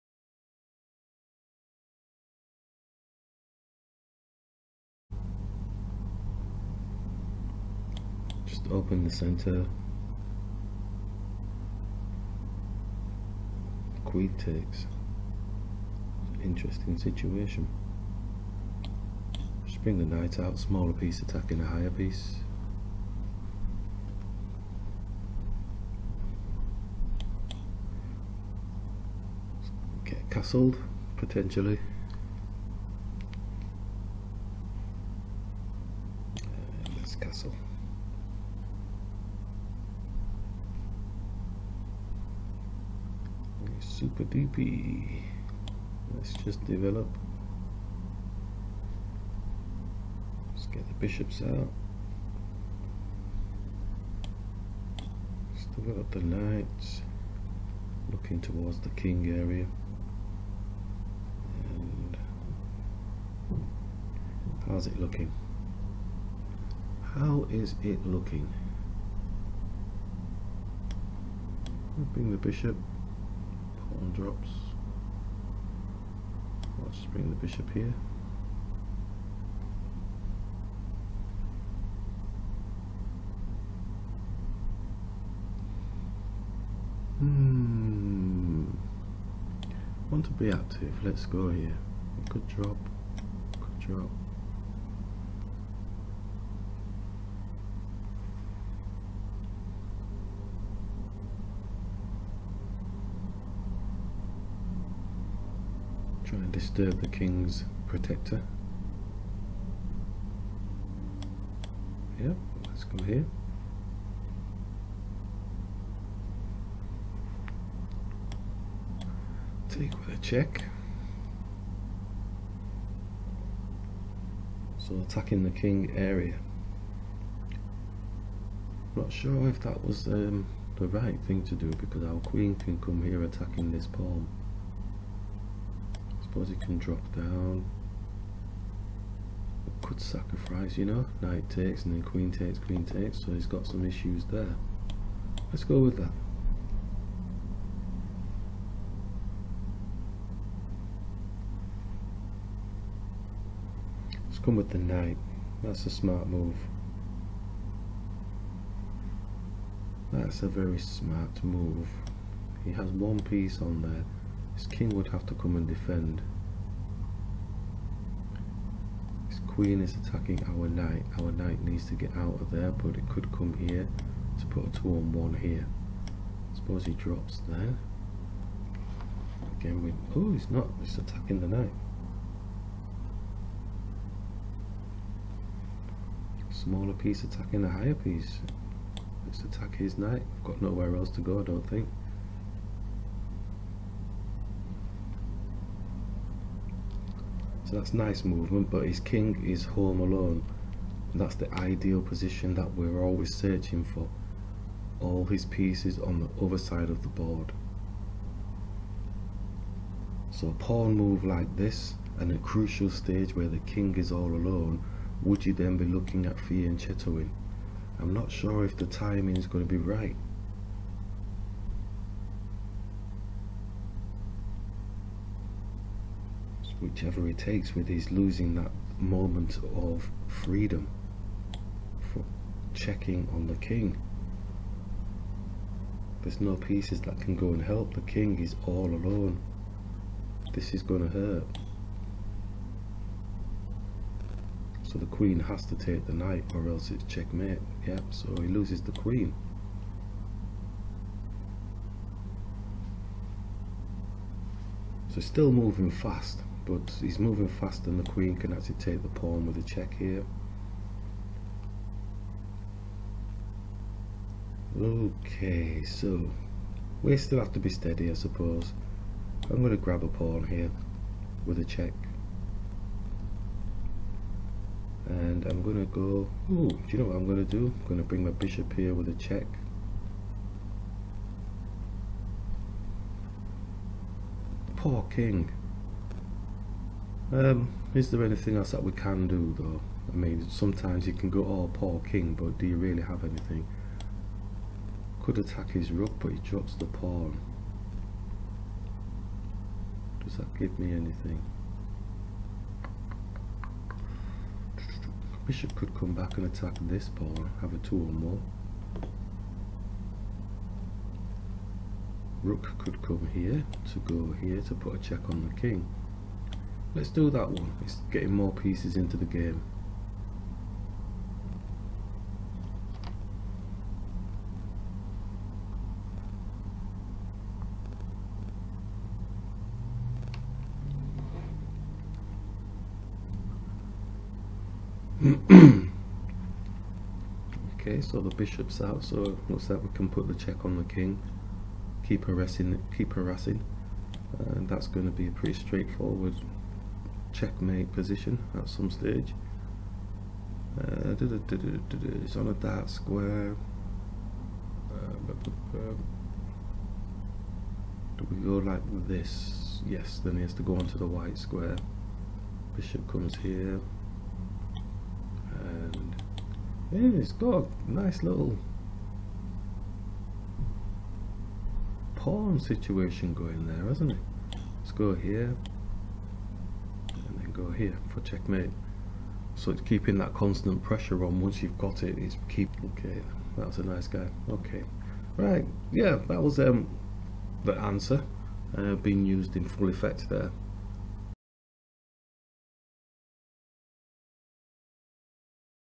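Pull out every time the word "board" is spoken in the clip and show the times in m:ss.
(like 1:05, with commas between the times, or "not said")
3:27.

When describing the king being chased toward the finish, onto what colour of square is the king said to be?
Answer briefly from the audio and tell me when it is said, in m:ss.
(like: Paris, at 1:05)
Dark, at 5:52.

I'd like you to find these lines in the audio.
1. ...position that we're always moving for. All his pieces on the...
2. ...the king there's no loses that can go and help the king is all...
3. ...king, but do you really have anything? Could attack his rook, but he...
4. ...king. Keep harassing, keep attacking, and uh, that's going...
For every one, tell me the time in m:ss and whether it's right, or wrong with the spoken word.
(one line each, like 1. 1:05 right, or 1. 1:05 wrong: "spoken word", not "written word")
1. 3:22 wrong: "searching", not "moving"
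2. 3:53 wrong: "pieces", not "loses"
3. 4:52 right
4. 5:40 wrong: "harassing", not "attacking".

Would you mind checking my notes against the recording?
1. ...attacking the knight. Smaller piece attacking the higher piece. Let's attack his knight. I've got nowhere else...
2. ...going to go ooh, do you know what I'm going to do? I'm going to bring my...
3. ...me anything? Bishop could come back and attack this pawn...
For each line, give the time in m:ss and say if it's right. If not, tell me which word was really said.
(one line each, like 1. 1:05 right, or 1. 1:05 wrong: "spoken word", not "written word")
1. 3:00 right
2. 4:35 right
3. 5:00 right.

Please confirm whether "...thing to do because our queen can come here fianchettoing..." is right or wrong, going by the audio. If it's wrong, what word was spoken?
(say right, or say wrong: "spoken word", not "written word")
wrong: "attacking", not "fianchettoing".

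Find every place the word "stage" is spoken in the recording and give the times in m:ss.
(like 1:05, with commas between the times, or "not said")
3:32, 5:48.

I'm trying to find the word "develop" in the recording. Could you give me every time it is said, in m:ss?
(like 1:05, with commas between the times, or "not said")
0:46, 0:55.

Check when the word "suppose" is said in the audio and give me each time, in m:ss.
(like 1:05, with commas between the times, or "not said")
2:16, 2:56, 4:28.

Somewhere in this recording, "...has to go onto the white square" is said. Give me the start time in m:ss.
6:00.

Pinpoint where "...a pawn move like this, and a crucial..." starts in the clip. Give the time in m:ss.
3:30.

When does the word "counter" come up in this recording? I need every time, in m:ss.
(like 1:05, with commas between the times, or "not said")
not said.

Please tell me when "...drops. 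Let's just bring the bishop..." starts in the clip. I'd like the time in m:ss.
1:14.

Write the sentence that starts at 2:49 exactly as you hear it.
His queen is attacking our knight.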